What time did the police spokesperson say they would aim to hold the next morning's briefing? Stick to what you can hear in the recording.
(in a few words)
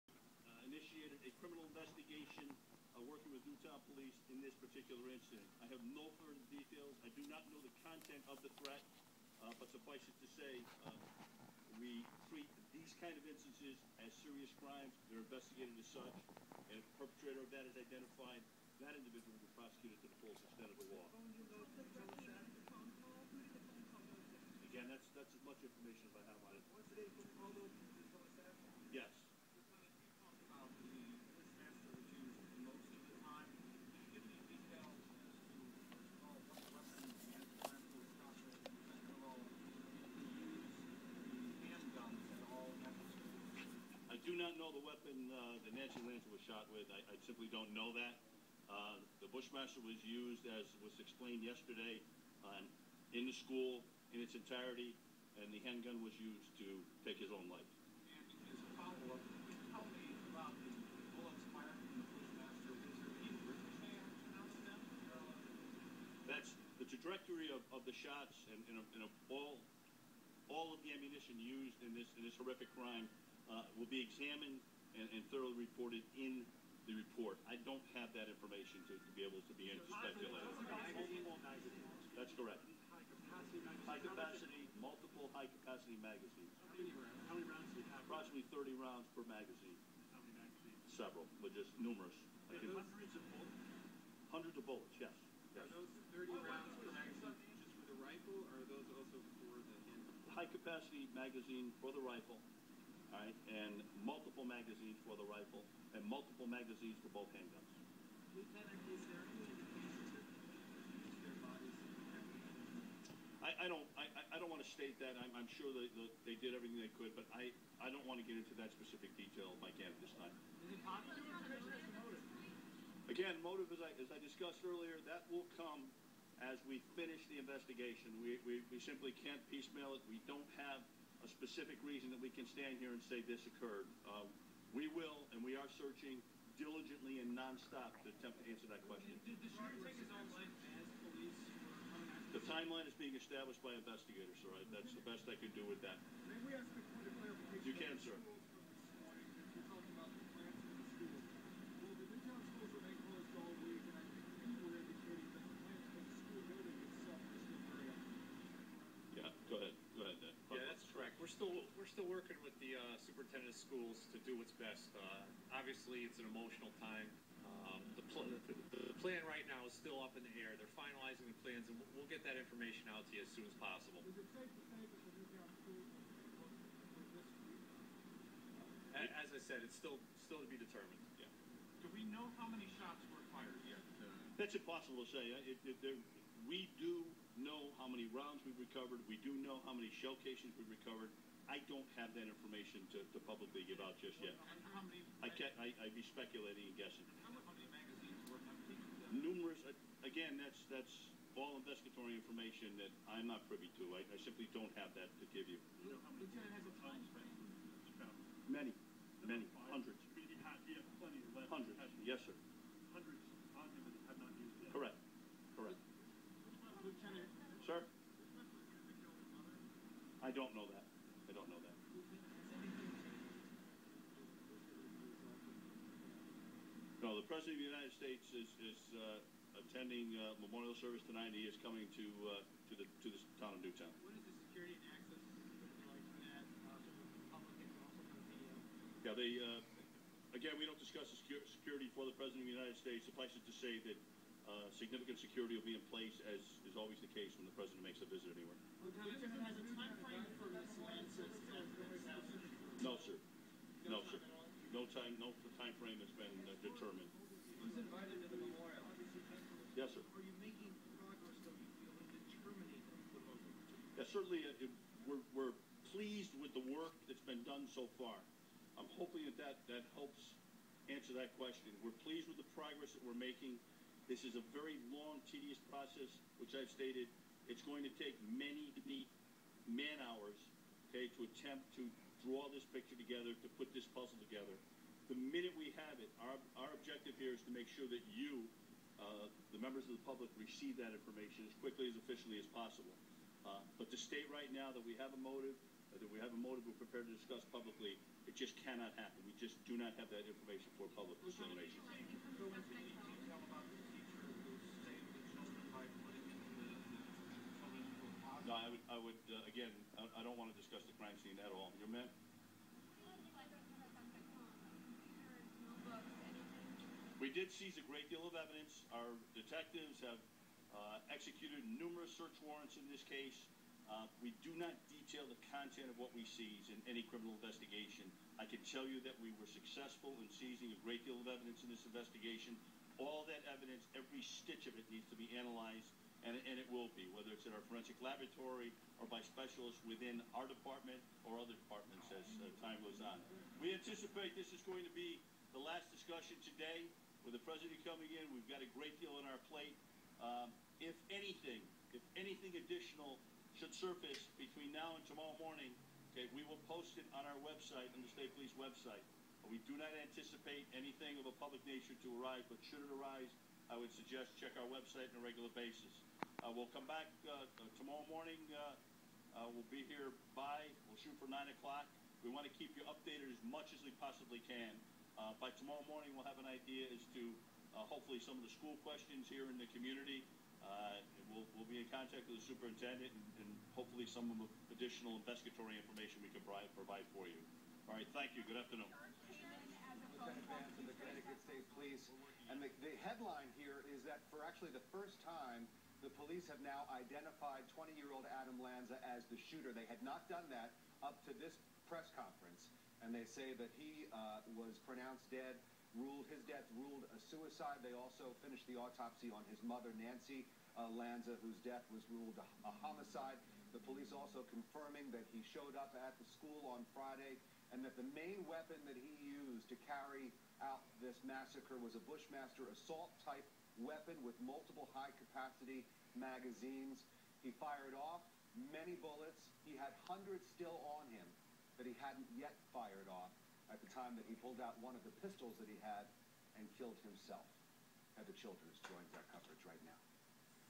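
9 o'clock.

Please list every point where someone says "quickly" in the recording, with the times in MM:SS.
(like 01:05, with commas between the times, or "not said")
04:51.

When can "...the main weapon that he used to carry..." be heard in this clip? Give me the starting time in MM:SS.
06:57.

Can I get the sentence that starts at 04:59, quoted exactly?
We just do not have that information for public consideration.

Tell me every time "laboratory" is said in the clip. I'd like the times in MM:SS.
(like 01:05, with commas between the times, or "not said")
05:37.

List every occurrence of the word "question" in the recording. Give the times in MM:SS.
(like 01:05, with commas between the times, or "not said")
02:18, 04:31, 06:18.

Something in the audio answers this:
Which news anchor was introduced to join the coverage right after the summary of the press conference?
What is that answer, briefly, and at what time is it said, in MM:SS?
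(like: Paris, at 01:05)
Heather Childers, at 07:18.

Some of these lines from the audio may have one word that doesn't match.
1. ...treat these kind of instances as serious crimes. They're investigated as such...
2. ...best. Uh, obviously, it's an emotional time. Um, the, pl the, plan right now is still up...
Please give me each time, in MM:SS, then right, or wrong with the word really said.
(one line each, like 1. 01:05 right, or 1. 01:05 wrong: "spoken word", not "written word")
1. 00:12 right
2. 02:44 right.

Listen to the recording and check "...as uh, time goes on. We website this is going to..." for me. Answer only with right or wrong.
wrong.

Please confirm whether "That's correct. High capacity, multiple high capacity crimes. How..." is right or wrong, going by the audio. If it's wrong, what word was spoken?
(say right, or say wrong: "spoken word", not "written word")
wrong: "magazines", not "crimes".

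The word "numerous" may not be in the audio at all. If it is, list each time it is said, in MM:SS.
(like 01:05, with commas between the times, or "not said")
01:31, 03:19, 05:21.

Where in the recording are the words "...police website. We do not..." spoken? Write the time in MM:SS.
05:58.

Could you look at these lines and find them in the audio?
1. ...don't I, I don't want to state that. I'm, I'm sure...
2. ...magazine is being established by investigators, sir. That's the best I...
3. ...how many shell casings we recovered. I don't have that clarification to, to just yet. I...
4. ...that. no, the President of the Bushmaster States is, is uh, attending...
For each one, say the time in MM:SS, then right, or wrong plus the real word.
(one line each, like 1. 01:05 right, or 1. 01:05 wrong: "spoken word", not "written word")
1. 01:53 right
2. 02:22 wrong: "timeline", not "magazine"
3. 03:09 wrong: "information", not "clarification"
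4. 03:41 wrong: "United", not "Bushmaster".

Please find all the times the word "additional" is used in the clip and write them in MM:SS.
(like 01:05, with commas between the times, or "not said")
05:52, 06:24.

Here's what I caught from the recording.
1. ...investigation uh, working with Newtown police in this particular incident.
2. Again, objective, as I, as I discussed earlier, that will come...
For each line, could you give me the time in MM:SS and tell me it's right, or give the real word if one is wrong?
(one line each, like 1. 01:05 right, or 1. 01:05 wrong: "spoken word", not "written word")
1. 00:01 right
2. 02:03 wrong: "motive", not "objective".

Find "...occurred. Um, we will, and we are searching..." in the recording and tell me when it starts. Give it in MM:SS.
02:13.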